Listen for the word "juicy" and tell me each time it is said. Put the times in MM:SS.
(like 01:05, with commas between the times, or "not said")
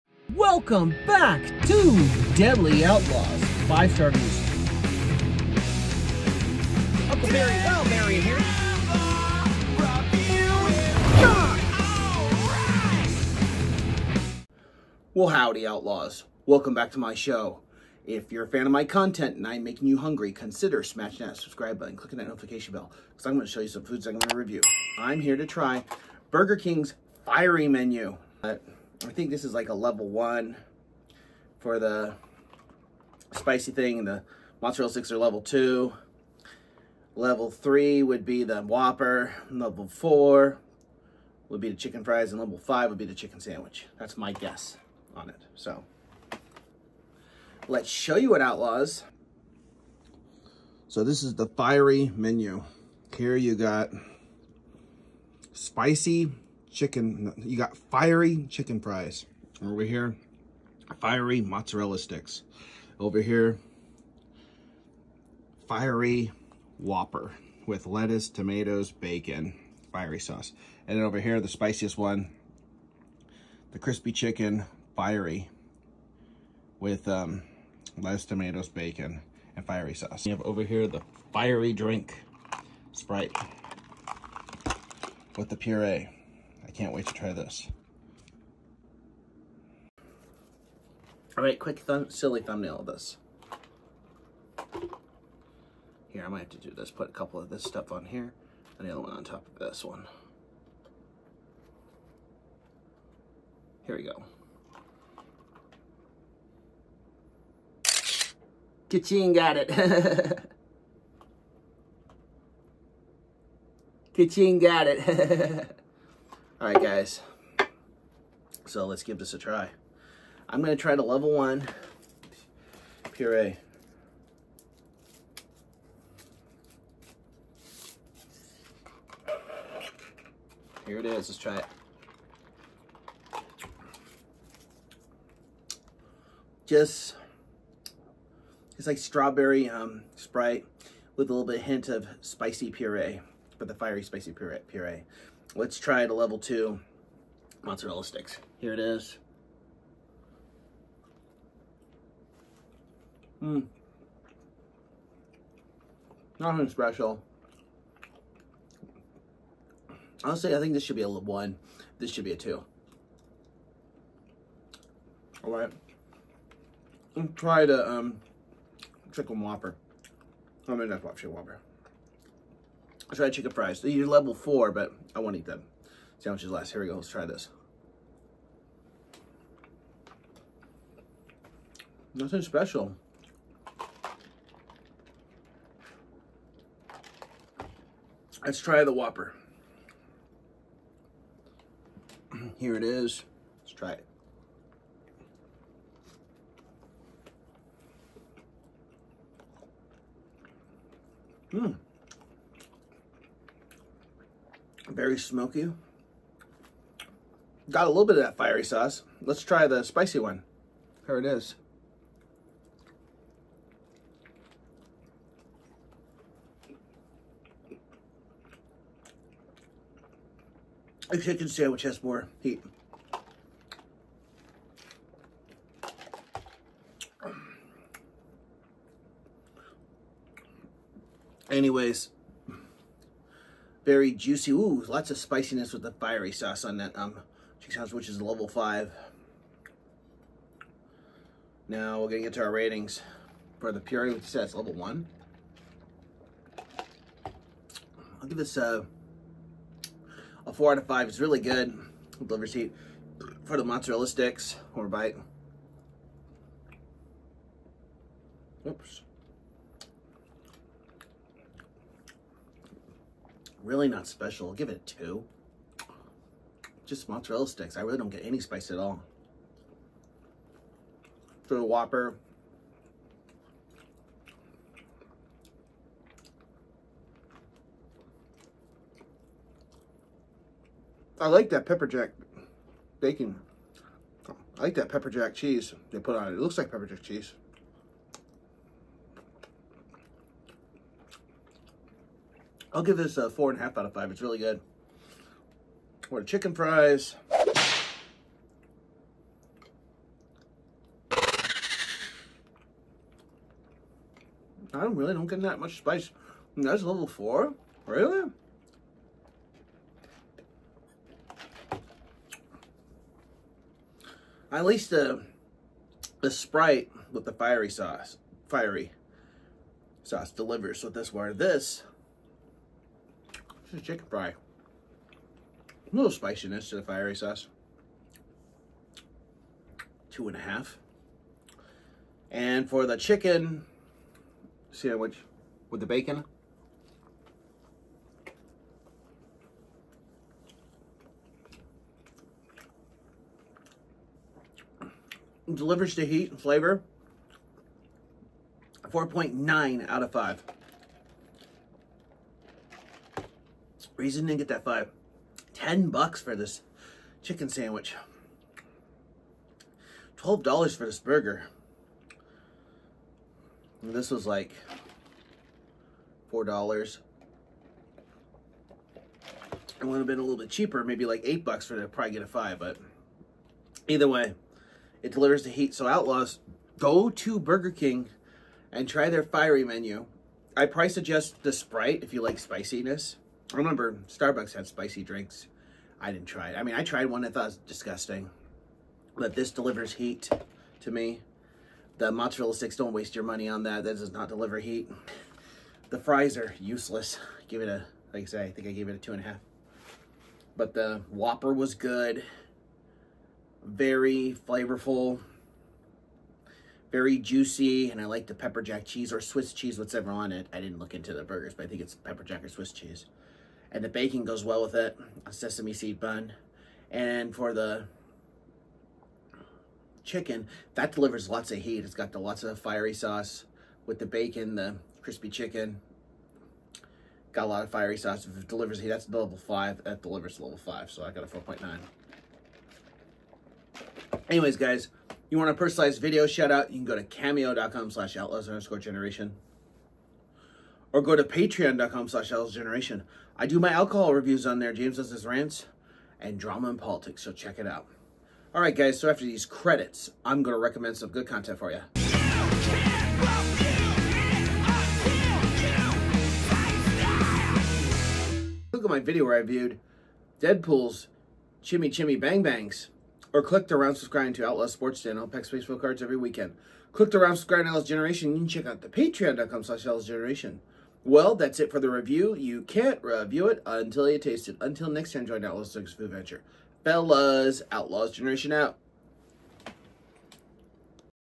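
03:54, 06:47.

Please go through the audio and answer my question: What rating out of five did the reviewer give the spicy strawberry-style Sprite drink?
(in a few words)
4.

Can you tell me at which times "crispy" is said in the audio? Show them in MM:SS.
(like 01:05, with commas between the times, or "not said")
01:13, 07:05.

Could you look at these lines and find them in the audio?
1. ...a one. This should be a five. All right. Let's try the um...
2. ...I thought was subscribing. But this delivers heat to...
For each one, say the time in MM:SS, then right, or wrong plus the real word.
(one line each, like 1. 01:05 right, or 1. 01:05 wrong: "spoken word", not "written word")
1. 02:41 wrong: "two", not "five"
2. 06:27 wrong: "disgusting", not "subscribing".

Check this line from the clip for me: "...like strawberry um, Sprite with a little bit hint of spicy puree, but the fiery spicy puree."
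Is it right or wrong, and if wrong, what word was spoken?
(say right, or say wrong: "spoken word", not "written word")
right.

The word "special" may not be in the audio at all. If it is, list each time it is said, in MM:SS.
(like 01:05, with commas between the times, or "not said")
02:36, 03:02, 04:24.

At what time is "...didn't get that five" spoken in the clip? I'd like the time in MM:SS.
05:54.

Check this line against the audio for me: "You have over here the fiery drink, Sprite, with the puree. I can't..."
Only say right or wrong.
right.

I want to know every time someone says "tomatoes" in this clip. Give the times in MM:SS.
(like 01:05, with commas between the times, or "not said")
01:08, 01:18.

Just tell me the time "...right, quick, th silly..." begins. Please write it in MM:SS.
01:31.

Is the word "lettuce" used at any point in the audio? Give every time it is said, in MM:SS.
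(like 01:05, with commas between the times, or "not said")
01:07, 01:17.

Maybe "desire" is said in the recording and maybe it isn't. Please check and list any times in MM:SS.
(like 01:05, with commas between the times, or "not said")
not said.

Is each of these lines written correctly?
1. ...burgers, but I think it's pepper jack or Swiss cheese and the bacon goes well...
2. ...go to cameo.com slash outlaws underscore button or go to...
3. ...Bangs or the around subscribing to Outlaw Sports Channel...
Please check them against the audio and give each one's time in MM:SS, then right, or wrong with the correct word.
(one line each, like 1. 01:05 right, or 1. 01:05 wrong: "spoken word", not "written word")
1. 06:51 right
2. 07:16 wrong: "generation", not "button"
3. 07:42 right.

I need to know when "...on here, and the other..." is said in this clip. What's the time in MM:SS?
01:37.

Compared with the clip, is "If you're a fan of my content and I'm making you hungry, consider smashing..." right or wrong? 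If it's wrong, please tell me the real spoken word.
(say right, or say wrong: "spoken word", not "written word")
right.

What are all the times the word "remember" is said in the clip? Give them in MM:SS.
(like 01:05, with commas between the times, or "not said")
06:23.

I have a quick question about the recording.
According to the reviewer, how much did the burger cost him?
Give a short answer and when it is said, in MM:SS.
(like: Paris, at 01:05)
$12, at 06:00.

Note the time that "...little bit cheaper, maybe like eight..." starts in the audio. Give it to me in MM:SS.
06:10.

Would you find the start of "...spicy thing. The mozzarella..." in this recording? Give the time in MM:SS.
00:33.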